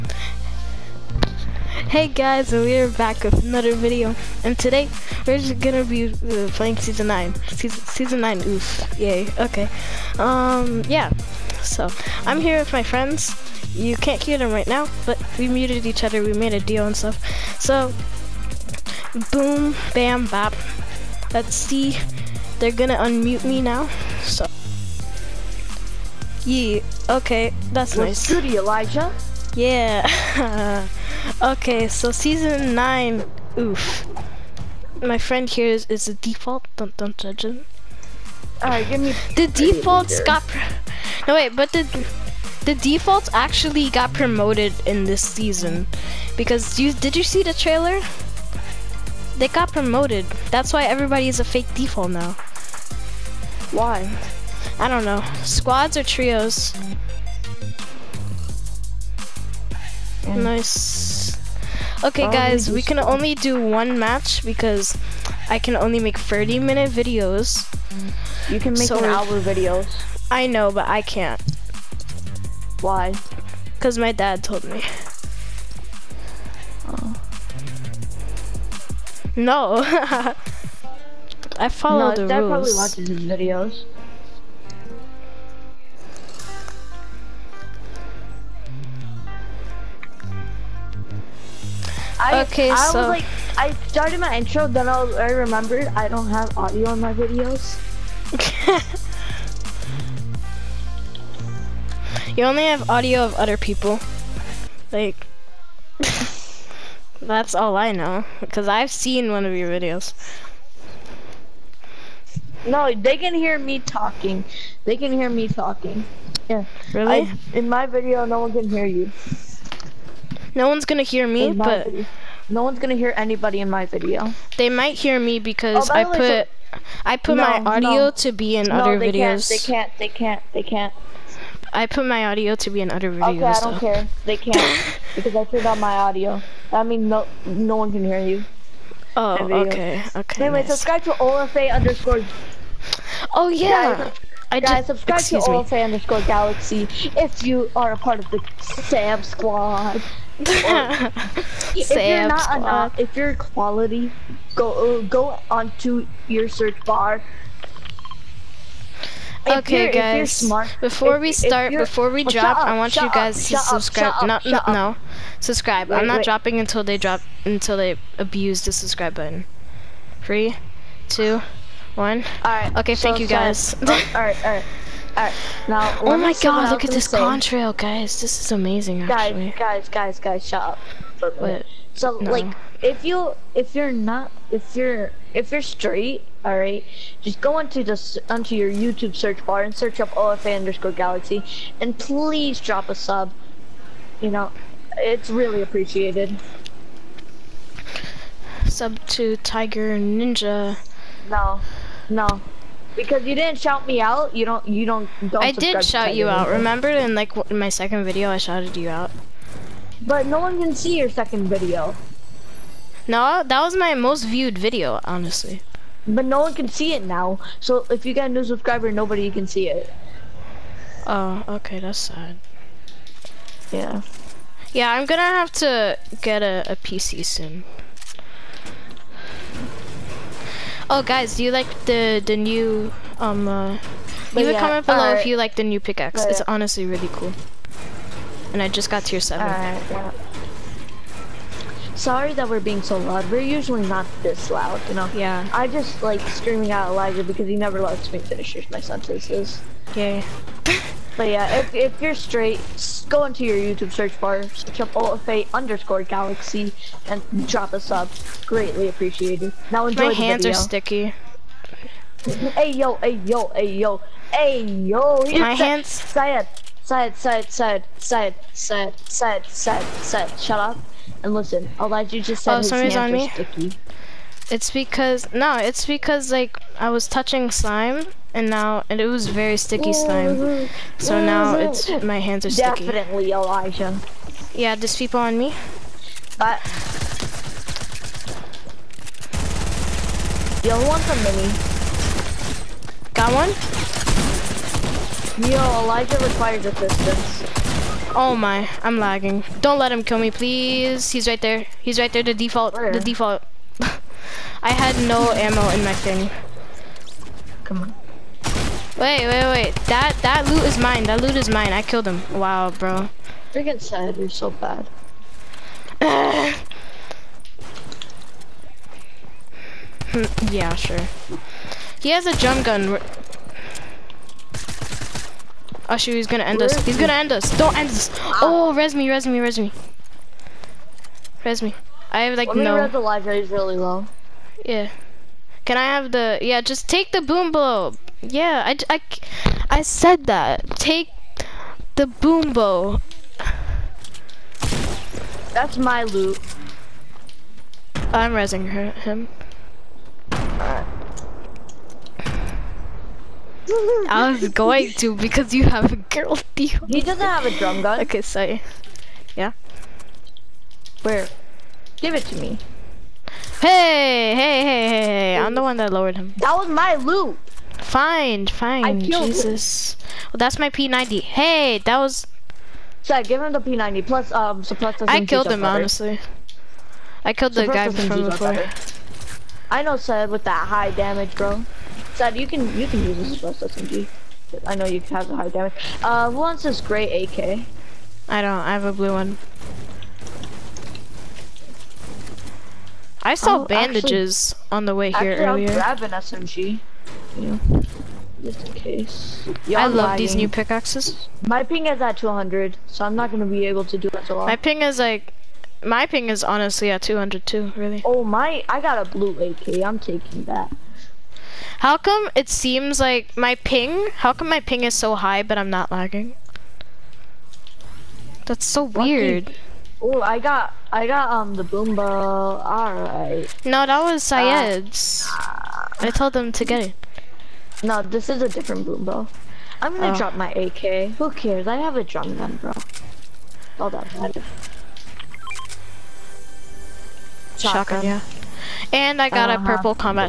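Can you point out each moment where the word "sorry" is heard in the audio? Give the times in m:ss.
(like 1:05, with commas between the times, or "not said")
4:01, 5:58.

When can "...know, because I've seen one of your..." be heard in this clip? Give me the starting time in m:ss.
1:47.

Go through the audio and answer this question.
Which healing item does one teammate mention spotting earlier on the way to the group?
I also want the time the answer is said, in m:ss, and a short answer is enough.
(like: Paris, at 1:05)
bandages, at 6:33.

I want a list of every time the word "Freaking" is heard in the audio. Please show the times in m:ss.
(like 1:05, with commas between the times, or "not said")
5:13.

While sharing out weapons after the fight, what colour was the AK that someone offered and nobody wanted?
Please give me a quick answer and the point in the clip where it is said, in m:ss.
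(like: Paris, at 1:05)
gray, at 6:26.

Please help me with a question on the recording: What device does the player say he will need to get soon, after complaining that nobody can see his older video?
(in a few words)
a PC.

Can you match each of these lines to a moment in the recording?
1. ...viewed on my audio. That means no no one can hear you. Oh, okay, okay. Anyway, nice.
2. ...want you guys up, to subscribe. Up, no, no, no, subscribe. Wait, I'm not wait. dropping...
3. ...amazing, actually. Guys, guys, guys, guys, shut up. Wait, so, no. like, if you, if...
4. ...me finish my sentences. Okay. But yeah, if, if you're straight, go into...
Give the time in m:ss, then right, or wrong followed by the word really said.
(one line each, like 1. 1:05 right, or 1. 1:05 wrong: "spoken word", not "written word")
1. 2:15 wrong: "turned", not "viewed"
2. 2:42 right
3. 2:58 right
4. 4:08 right.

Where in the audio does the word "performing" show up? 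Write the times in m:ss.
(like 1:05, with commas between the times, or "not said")
not said.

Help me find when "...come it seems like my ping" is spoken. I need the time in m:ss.
6:51.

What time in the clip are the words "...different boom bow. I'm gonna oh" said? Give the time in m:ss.
7:08.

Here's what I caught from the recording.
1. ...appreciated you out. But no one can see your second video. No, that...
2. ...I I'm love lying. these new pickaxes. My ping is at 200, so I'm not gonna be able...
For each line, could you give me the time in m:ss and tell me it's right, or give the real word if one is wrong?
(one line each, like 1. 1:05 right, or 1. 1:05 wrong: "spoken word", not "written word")
1. 3:28 wrong: "shouted", not "appreciated"
2. 6:39 right.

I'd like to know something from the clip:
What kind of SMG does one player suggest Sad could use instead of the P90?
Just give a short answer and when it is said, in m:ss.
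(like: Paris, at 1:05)
suppressor SMG, at 6:23.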